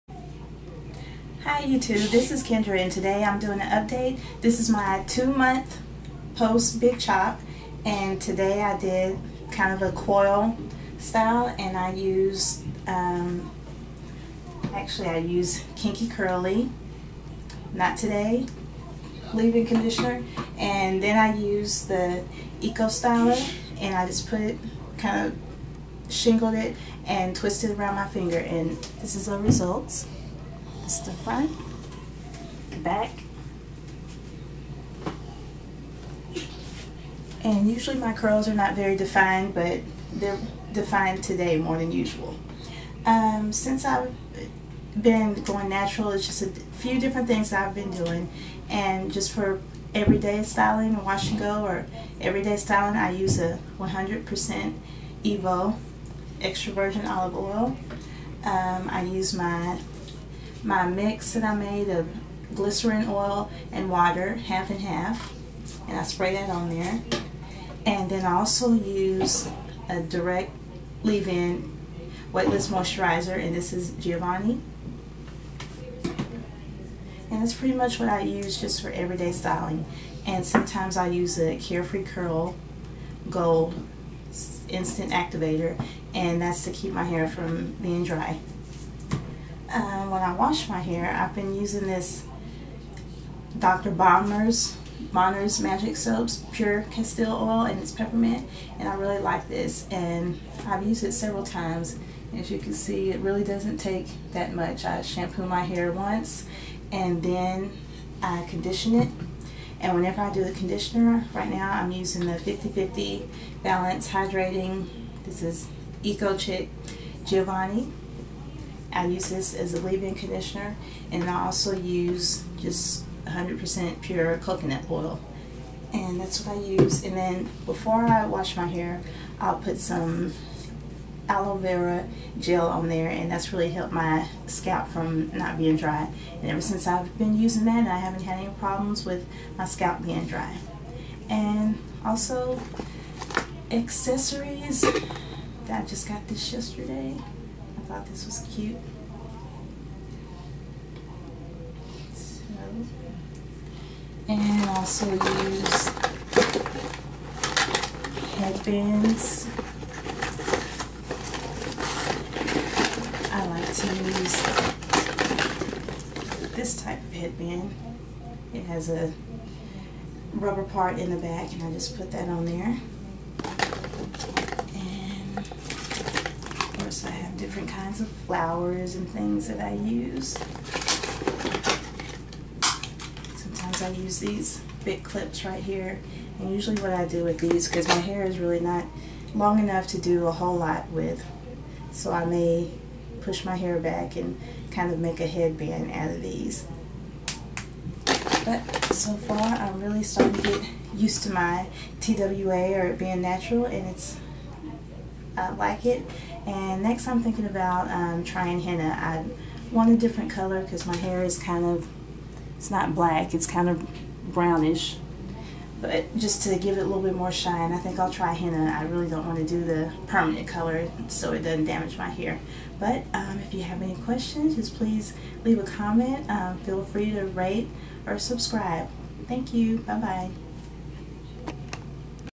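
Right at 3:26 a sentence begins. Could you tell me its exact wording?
And next I'm thinking about um, trying henna.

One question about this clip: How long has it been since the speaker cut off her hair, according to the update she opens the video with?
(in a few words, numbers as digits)
2 months.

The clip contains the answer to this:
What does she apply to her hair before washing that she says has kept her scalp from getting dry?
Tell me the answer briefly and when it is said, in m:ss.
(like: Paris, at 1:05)
Aloe vera gel, at 2:11.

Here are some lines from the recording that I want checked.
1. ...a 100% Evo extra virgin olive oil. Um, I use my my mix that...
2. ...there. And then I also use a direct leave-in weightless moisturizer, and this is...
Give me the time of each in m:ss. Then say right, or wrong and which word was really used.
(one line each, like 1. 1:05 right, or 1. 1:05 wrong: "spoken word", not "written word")
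1. 0:53 right
2. 1:06 right.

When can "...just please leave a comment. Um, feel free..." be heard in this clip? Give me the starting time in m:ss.
3:44.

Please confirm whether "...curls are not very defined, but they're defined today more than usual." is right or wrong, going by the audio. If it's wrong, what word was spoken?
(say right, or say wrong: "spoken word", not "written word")
right.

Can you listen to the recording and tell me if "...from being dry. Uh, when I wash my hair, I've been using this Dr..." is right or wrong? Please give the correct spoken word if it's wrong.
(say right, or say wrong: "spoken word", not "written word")
right.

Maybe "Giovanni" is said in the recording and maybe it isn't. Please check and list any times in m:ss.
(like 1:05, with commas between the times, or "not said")
1:13, 1:57.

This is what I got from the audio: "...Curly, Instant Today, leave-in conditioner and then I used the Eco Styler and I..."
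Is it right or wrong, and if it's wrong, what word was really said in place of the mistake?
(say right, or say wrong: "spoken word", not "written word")
wrong: "Knot", not "Instant".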